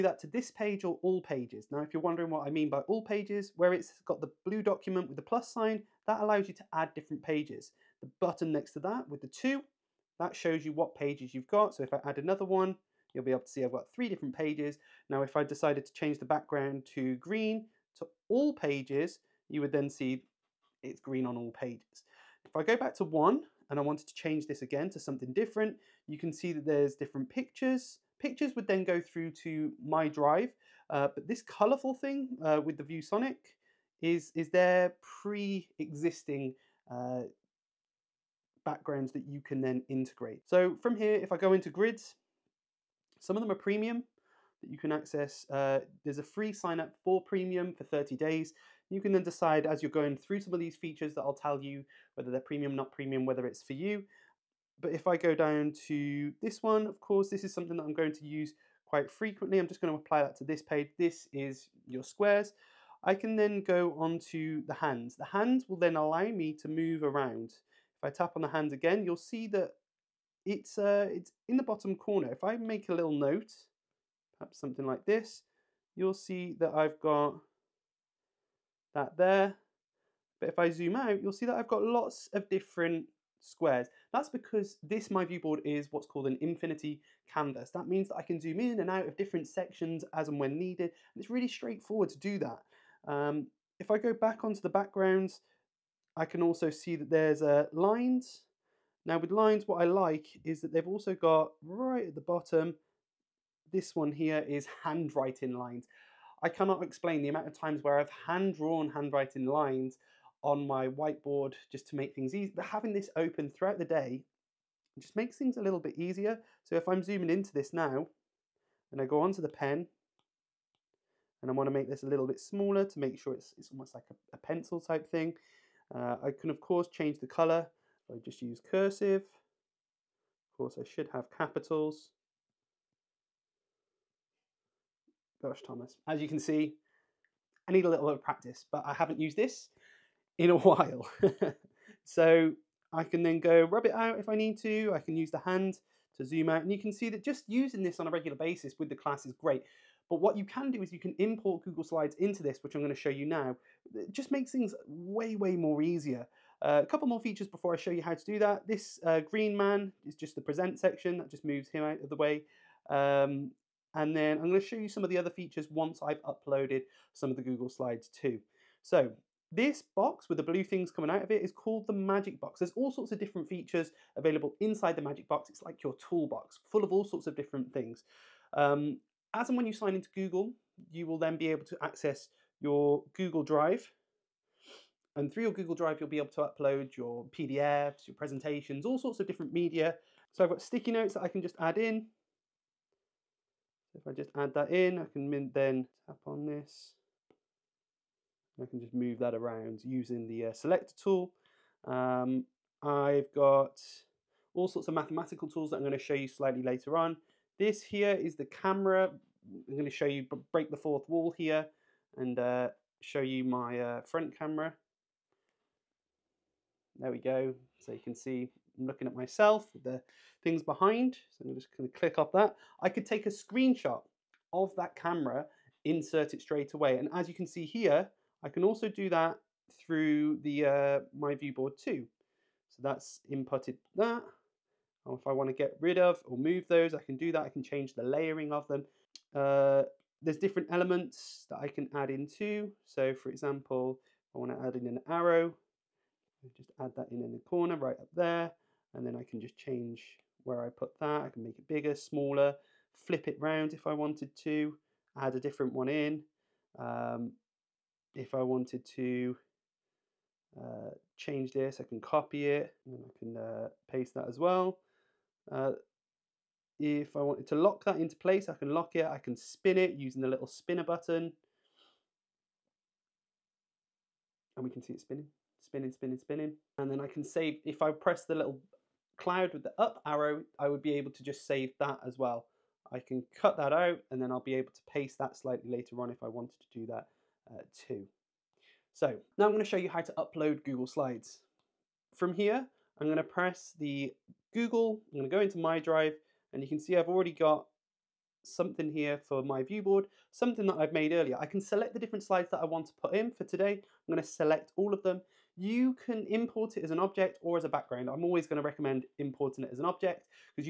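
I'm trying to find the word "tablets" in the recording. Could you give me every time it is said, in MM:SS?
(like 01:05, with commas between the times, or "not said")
not said.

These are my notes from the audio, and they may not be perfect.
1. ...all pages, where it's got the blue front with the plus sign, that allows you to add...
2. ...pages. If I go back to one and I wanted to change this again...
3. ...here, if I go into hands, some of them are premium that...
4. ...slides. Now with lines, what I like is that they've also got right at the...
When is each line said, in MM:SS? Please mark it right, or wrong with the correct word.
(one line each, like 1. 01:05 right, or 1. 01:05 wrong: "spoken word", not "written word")
1. 00:02 wrong: "document", not "front"
2. 00:21 right
3. 00:40 wrong: "grids", not "hands"
4. 01:37 wrong: "lines", not "slides".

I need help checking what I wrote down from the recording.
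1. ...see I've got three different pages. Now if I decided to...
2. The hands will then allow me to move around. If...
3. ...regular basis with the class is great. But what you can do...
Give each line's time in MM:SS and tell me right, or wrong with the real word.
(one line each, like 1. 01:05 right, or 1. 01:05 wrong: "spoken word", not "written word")
1. 00:13 right
2. 01:05 right
3. 02:28 right.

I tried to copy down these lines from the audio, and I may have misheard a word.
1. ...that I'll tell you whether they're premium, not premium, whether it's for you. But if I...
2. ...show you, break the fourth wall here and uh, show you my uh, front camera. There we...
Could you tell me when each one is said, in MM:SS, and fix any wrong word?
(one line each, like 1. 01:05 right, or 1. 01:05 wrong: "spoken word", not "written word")
1. 00:51 right
2. 03:29 right.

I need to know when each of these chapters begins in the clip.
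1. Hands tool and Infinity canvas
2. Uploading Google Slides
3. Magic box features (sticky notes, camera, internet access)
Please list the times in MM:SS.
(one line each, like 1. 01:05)
1. 02:24
2. 04:44
3. 02:54.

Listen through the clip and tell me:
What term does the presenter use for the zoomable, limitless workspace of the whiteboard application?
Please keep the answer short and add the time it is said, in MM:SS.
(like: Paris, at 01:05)
infinity canvas, at 01:26.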